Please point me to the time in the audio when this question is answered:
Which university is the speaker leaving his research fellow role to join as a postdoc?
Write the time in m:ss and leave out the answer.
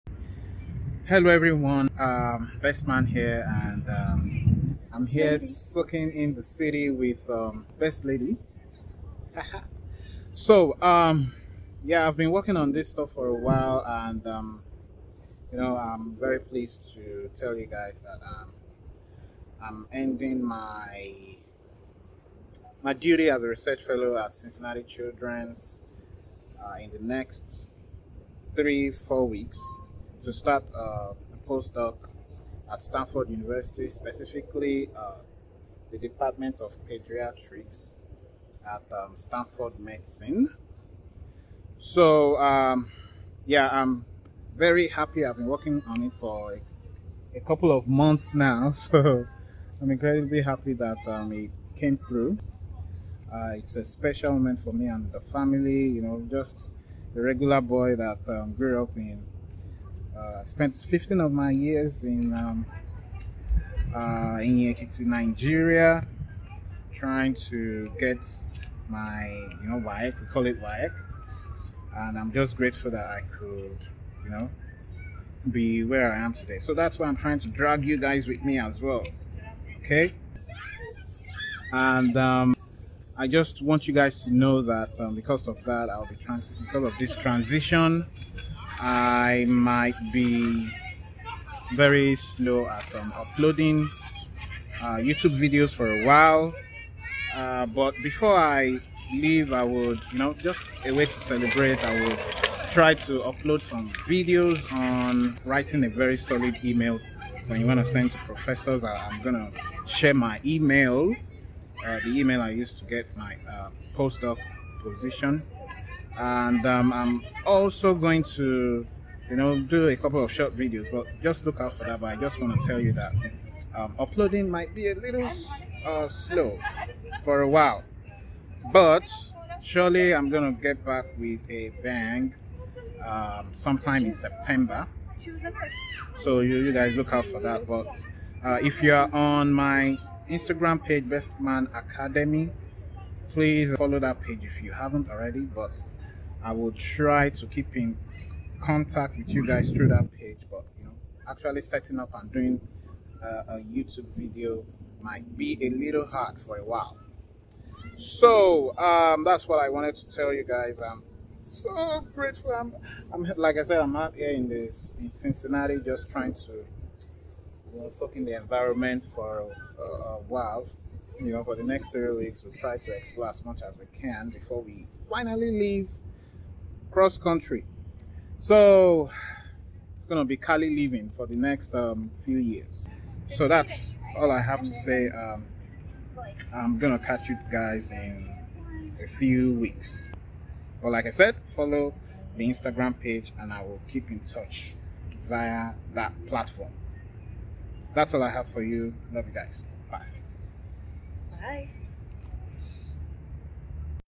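0:32.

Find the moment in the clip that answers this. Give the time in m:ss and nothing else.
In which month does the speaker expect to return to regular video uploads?
2:14.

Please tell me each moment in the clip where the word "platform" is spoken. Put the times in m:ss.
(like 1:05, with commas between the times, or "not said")
3:16.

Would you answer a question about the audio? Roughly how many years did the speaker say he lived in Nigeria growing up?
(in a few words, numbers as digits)
15.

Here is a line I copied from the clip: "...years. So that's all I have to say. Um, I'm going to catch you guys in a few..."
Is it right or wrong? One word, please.
right.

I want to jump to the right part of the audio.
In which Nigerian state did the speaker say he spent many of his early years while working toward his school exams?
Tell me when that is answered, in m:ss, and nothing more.
1:04.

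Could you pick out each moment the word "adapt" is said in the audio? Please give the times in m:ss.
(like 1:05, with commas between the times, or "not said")
not said.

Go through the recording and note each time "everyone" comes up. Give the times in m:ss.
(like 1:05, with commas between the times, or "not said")
0:01.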